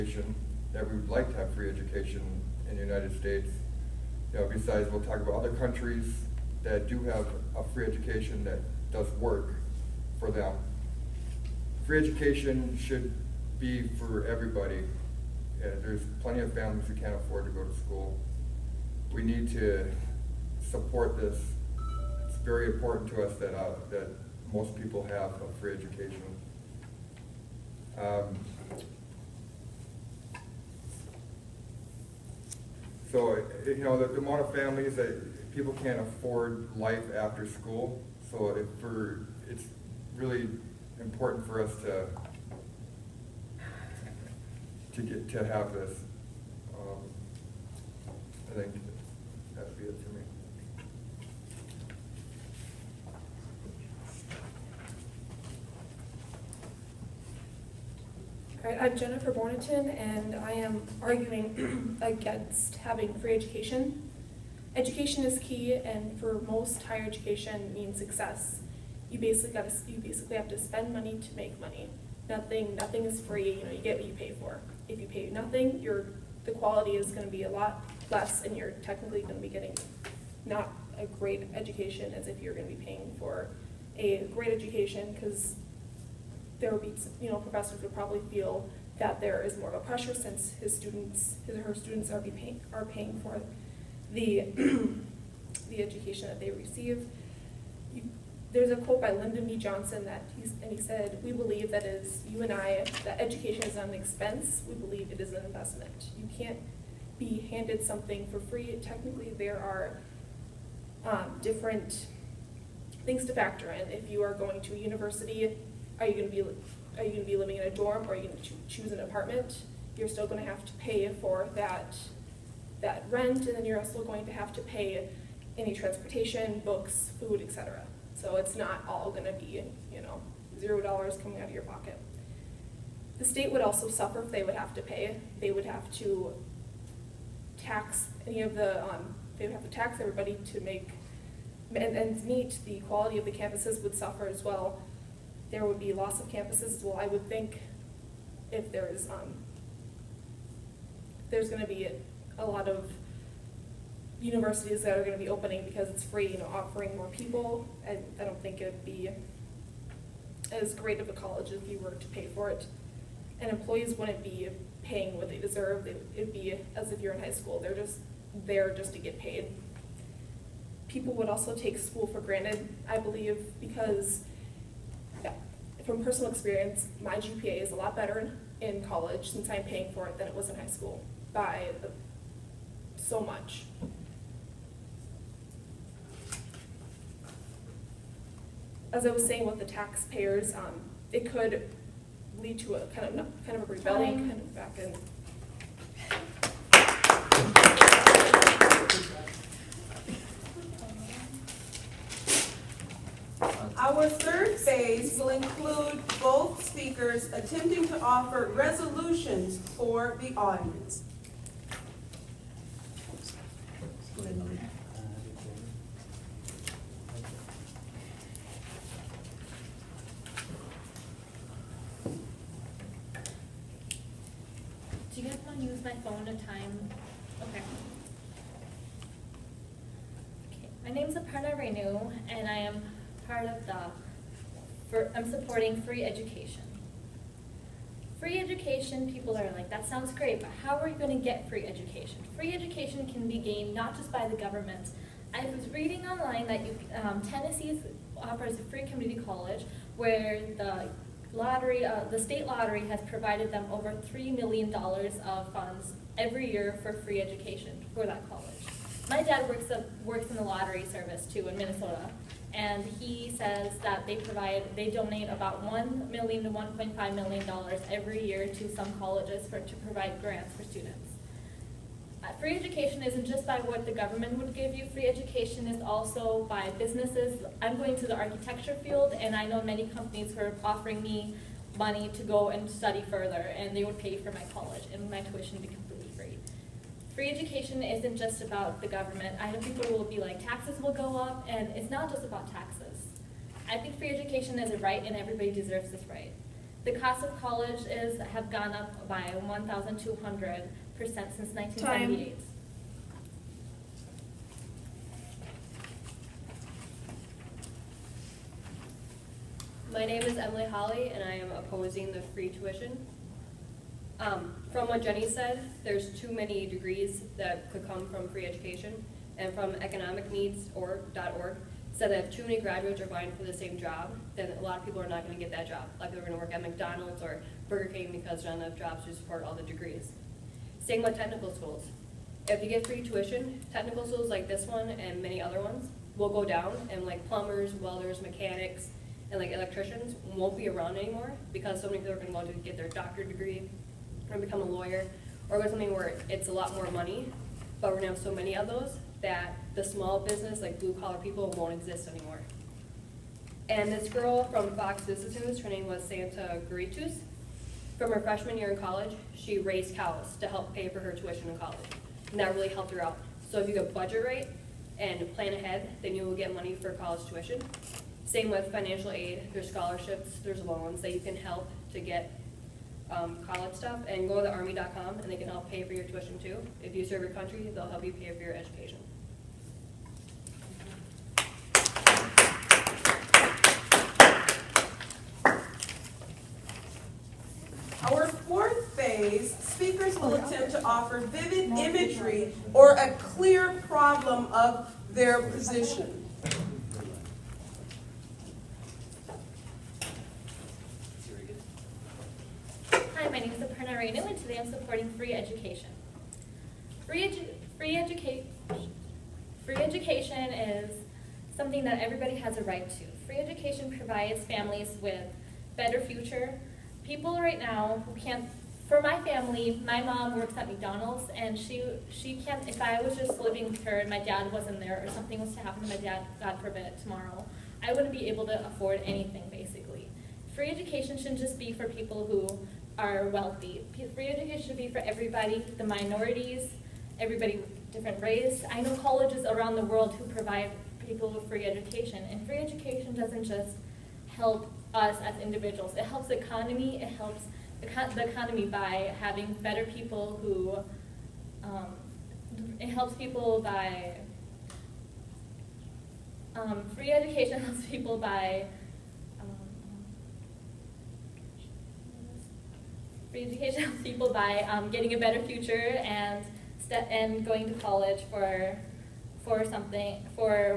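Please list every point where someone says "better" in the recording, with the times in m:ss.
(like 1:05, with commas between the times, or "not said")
2:57, 6:55, 7:29, 7:45.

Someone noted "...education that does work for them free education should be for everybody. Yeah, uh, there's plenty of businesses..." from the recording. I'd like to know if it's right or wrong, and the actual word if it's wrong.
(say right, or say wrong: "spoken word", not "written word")
wrong: "families", not "businesses".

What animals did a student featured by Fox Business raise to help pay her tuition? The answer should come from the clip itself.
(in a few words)
Cows.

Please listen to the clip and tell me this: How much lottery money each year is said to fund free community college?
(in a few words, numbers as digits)
Over $3 million.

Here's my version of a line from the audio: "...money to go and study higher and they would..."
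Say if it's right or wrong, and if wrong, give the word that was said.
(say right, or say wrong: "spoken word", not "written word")
wrong: "further", not "higher".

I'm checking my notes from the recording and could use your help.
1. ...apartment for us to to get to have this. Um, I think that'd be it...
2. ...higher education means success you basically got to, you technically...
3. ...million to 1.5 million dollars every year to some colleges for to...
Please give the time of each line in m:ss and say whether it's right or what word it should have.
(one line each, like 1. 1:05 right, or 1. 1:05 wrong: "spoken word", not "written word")
1. 0:40 wrong: "important", not "apartment"
2. 1:06 wrong: "basically", not "technically"
3. 4:26 right.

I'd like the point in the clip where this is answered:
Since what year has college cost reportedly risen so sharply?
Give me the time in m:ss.
5:01.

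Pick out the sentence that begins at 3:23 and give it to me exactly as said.
Our third phase will include both speakers attempting to offer resolutions for the audience.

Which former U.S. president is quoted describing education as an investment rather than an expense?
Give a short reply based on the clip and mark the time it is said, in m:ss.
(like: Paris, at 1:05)
Lyndon B. Johnson, at 1:39.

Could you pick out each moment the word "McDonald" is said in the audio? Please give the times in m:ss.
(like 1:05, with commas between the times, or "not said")
5:26, 7:00.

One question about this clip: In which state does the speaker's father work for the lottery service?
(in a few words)
Minnesota.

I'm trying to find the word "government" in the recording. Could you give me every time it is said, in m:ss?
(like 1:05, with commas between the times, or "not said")
4:04, 4:33, 4:48.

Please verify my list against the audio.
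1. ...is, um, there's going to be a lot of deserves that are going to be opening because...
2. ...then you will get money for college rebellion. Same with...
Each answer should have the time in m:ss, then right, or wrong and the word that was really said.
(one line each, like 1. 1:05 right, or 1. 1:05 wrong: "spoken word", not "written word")
1. 2:28 wrong: "universities", not "deserves"
2. 6:06 wrong: "tuition", not "rebellion".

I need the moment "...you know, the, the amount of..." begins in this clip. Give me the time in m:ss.
0:33.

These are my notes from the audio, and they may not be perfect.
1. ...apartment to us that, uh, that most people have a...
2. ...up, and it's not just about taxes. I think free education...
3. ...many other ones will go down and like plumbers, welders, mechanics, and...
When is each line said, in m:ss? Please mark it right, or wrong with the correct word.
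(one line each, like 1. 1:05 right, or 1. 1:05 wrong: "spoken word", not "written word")
1. 0:22 wrong: "important", not "apartment"
2. 4:51 right
3. 5:35 right.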